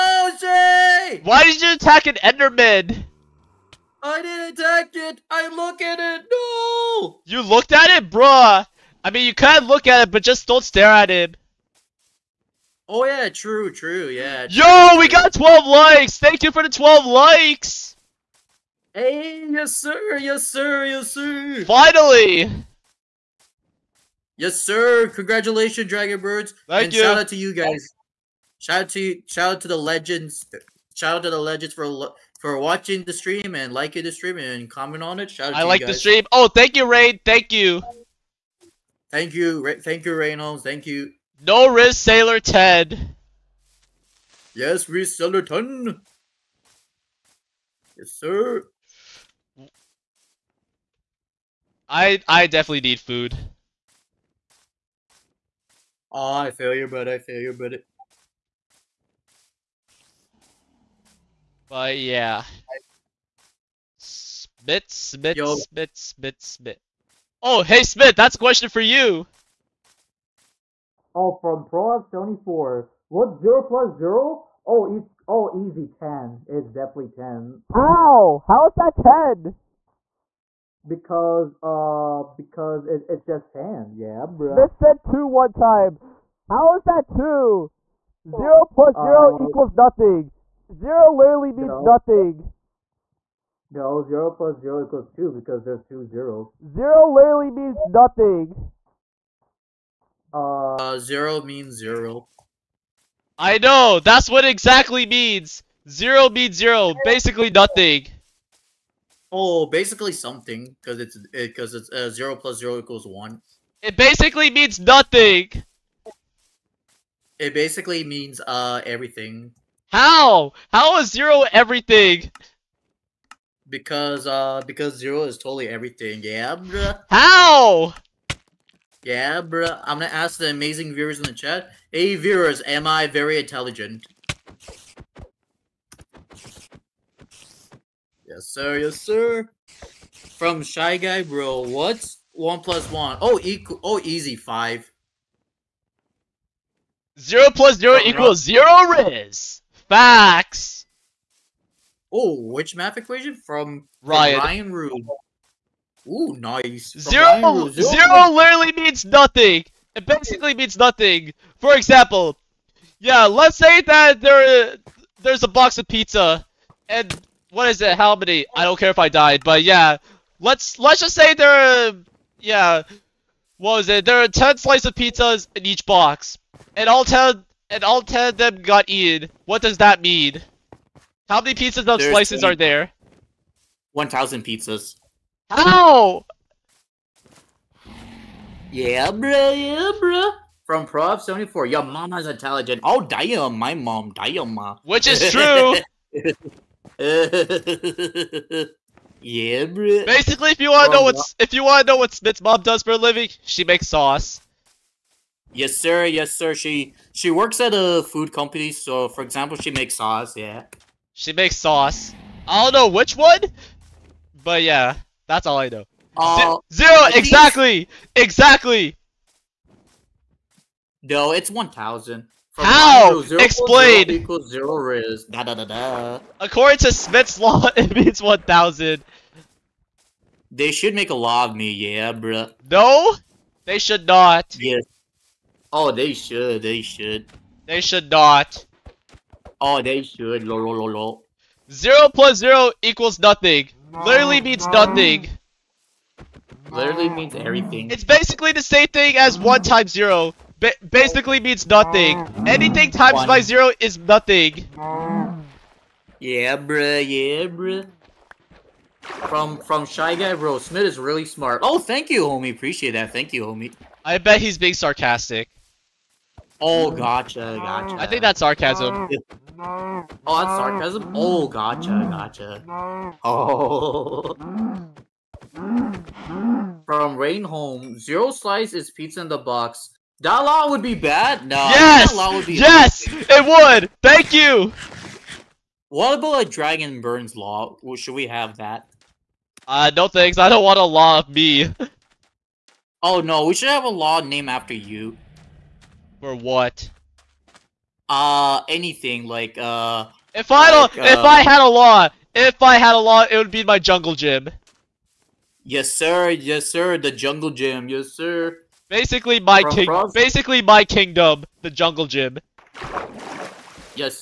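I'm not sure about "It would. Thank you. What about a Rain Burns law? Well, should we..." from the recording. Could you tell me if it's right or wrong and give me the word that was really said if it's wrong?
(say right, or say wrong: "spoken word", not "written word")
wrong: "Dragon", not "Rain".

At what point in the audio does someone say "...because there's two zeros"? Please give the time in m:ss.
1:35.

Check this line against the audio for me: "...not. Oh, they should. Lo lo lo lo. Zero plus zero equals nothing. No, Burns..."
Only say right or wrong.
wrong.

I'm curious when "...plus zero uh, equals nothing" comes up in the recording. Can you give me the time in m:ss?
1:28.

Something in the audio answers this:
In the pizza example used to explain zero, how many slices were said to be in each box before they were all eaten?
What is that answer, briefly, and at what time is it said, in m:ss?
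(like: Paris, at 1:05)
10, at 2:54.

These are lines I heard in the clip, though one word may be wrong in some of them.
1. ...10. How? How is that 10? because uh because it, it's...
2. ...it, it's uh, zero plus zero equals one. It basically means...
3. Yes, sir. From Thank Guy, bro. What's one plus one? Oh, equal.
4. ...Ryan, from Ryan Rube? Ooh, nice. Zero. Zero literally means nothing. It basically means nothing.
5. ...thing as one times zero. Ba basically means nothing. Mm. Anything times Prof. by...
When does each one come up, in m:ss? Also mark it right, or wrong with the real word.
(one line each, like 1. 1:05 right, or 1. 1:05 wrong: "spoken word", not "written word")
1. 1:17 right
2. 1:51 right
3. 2:18 wrong: "Shy", not "Thank"
4. 2:34 right
5. 4:08 wrong: "One", not "Prof".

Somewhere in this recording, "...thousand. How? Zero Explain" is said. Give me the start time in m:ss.
3:41.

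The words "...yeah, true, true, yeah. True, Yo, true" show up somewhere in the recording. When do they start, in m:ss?
0:13.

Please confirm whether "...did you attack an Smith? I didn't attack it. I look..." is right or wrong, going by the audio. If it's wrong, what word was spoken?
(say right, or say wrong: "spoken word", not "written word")
wrong: "Enderman", not "Smith".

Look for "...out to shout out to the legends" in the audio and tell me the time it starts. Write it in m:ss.
0:28.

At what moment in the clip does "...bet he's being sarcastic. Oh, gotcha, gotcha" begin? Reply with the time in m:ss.
4:24.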